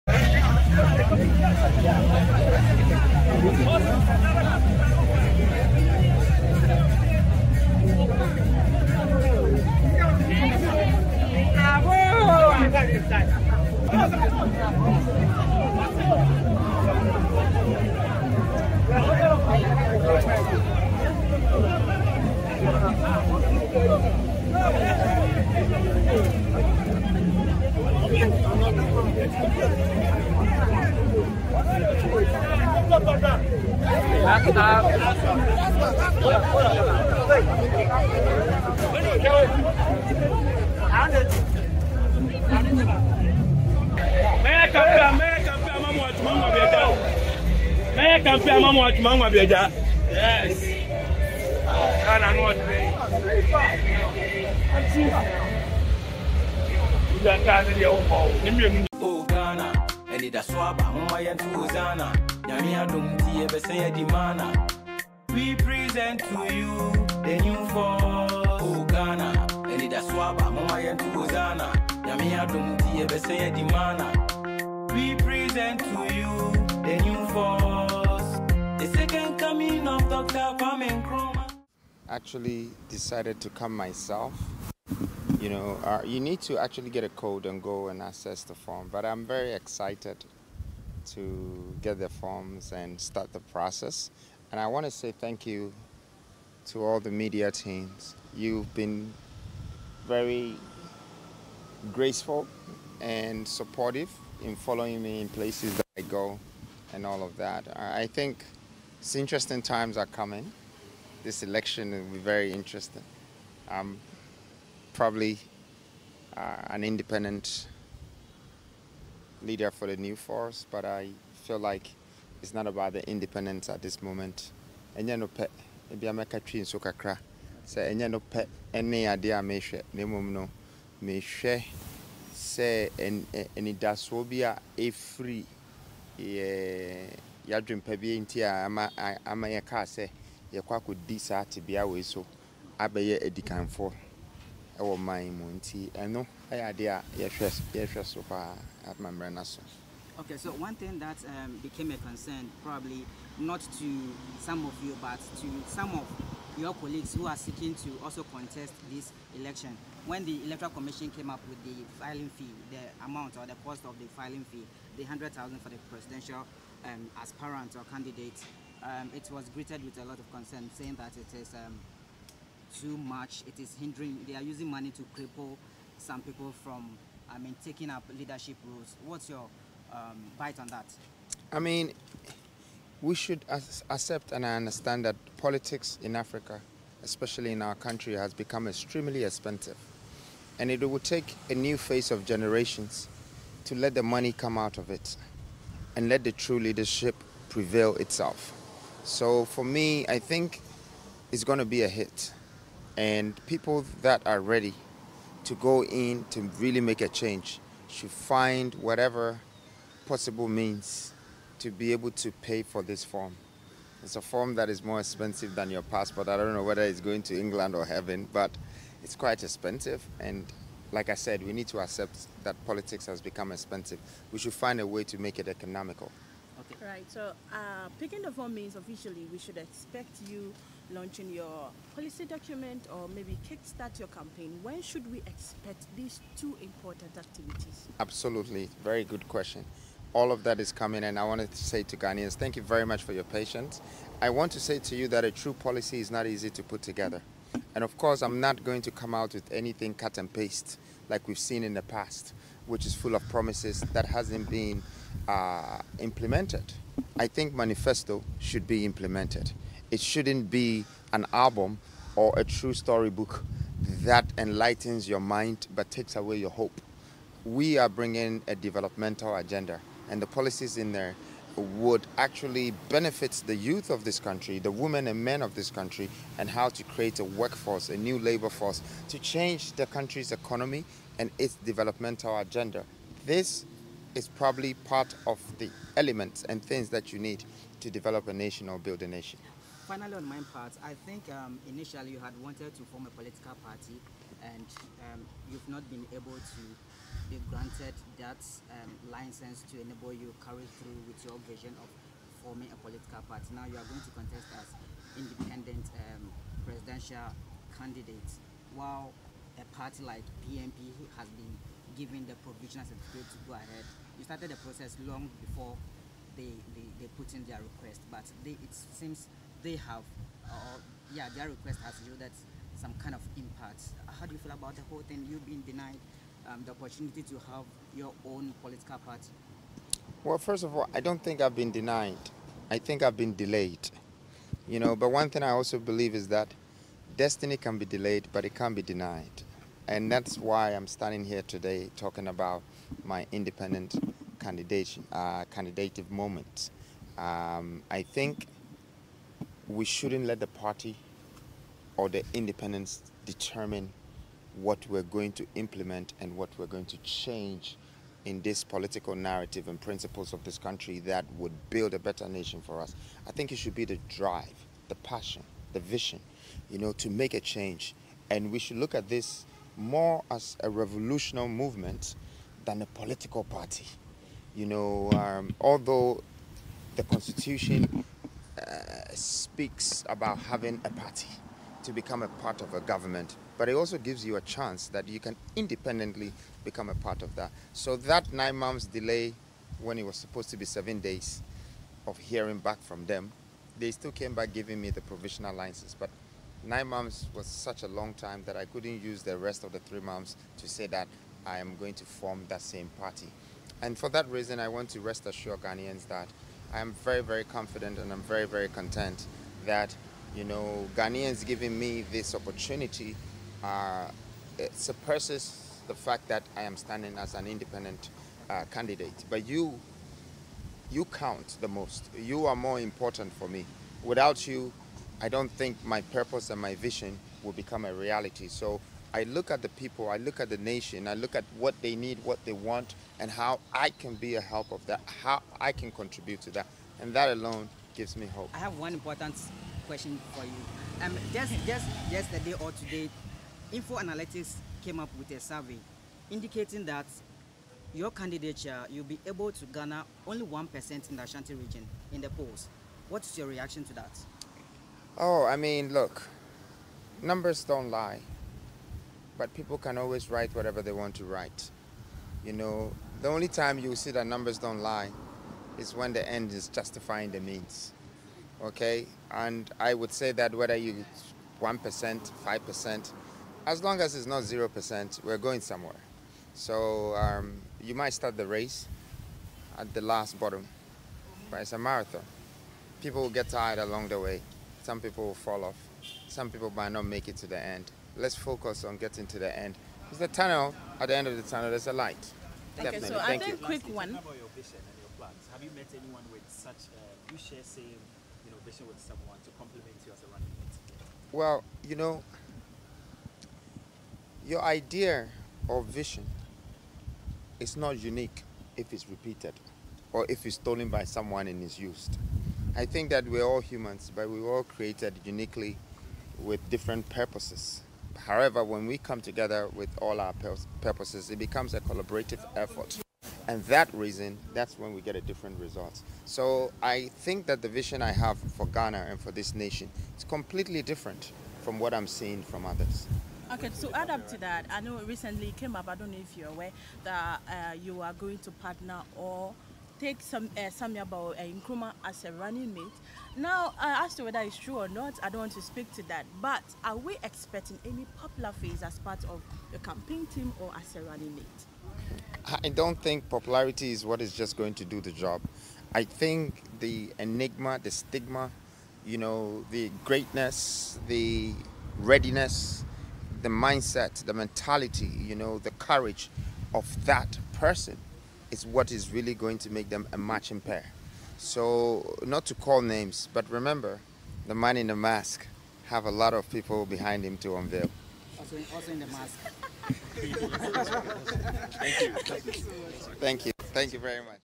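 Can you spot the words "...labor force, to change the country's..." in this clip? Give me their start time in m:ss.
4:38.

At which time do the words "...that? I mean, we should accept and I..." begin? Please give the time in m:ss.
3:00.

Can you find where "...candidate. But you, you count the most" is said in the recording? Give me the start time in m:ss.
6:58.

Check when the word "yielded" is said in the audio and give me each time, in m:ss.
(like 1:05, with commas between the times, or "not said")
5:22.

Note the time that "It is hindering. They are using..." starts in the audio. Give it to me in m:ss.
2:53.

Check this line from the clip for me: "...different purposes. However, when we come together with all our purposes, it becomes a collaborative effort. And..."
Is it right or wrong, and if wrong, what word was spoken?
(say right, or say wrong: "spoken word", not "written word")
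right.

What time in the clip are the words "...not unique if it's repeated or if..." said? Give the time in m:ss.
8:27.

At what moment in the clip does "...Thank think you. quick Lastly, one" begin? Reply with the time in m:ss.
8:13.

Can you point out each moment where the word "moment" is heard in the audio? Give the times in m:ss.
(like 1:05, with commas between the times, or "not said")
2:04, 5:46.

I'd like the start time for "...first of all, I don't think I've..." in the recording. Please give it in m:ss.
5:30.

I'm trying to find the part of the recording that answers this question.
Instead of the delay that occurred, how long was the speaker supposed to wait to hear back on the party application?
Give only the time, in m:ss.
6:30.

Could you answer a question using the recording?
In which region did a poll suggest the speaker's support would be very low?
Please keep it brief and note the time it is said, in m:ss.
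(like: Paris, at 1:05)
Ashanti, at 7:31.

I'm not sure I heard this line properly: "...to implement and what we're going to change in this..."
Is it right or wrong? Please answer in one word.
right.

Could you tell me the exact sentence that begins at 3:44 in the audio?
We should find a way to make it economical.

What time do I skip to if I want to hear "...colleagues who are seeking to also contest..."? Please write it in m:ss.
2:36.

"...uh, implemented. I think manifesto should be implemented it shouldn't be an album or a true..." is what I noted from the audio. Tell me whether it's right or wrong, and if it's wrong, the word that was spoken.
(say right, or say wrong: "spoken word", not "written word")
right.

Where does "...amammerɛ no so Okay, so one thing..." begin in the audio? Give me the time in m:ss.
2:28.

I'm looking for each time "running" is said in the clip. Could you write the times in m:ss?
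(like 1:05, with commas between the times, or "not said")
8:20, 9:02, 9:11.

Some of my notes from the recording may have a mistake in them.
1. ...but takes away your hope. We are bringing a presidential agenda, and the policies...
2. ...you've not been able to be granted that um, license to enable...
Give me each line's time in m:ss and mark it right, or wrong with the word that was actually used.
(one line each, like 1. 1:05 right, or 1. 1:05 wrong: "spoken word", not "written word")
1. 4:25 wrong: "developmental", not "presidential"
2. 4:55 right.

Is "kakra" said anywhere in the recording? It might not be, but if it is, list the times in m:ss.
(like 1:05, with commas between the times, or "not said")
2:06.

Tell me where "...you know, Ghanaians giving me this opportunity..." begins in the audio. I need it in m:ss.
6:50.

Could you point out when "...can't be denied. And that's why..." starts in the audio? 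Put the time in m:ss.
5:38.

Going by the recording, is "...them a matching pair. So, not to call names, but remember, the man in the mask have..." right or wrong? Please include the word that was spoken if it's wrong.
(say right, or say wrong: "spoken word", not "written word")
right.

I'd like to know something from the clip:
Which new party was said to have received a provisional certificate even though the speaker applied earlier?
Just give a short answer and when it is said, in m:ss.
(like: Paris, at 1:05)
PMP, at 5:10.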